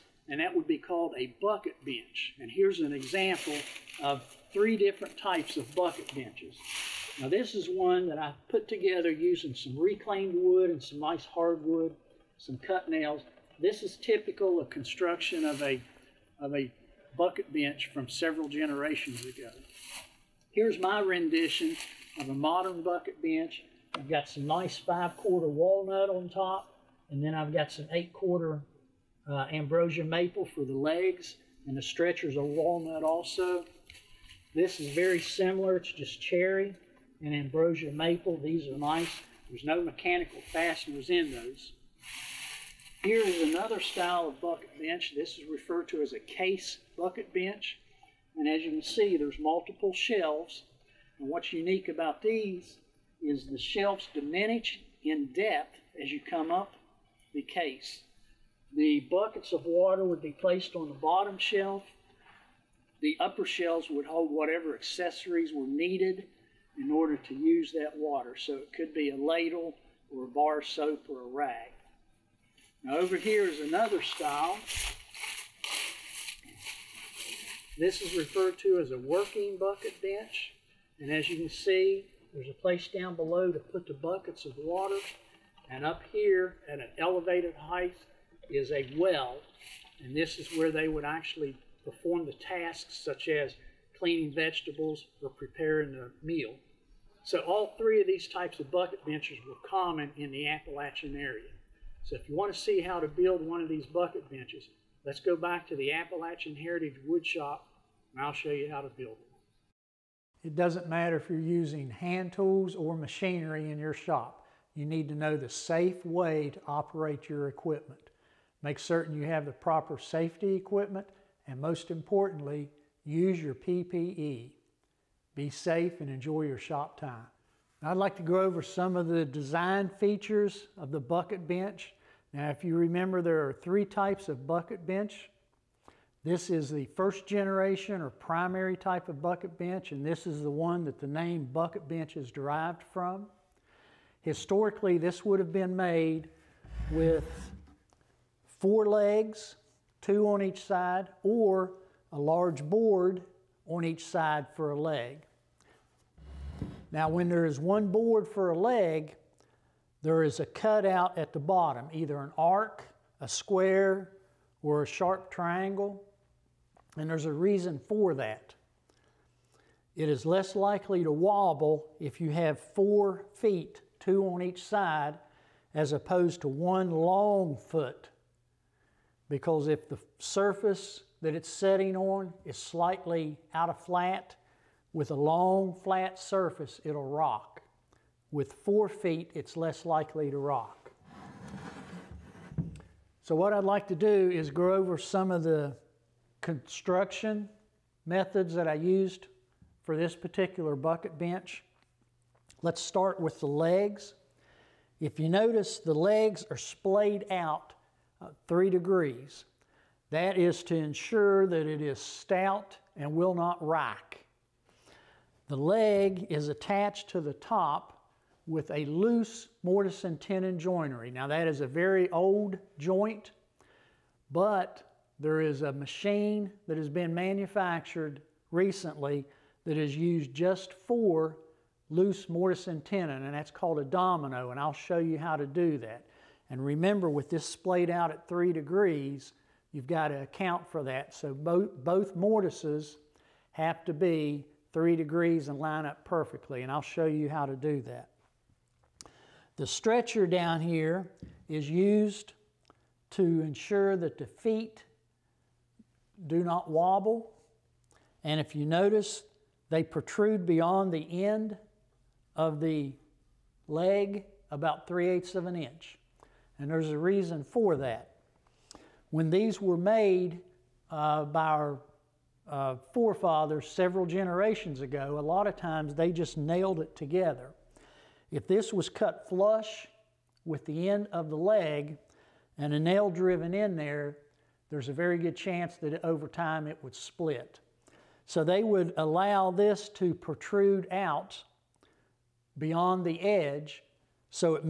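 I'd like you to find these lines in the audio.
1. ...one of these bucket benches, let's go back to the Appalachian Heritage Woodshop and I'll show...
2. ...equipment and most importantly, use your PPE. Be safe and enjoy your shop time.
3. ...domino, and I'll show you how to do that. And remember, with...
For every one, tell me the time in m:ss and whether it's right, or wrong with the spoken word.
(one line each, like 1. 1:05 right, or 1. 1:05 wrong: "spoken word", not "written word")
1. 1:43 right
2. 2:00 right
3. 3:53 right.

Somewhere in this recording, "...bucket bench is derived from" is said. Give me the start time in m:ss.
2:21.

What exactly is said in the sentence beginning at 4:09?
The stretcher down here is used to ensure that the feet do not wobble.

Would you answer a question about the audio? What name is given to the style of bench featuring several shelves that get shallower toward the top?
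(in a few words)
Case bucket bench.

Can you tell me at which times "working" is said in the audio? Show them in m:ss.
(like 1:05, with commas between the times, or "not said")
1:18.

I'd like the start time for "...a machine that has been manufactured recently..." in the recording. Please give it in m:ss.
3:45.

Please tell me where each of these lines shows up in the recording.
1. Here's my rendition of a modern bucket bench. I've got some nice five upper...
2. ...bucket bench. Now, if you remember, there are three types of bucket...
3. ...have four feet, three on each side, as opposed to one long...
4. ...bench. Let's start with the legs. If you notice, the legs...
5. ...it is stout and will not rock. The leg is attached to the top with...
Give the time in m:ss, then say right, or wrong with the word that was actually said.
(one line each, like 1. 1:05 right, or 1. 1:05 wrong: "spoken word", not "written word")
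1. 0:20 wrong: "quarter", not "upper"
2. 2:10 right
3. 2:52 wrong: "two", not "three"
4. 3:21 right
5. 3:31 right.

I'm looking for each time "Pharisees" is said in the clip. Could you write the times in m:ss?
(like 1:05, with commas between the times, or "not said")
not said.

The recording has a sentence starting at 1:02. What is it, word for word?
The upper shelves would hold whatever accessories were needed in order to use that water.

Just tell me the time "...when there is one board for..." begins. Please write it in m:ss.
2:37.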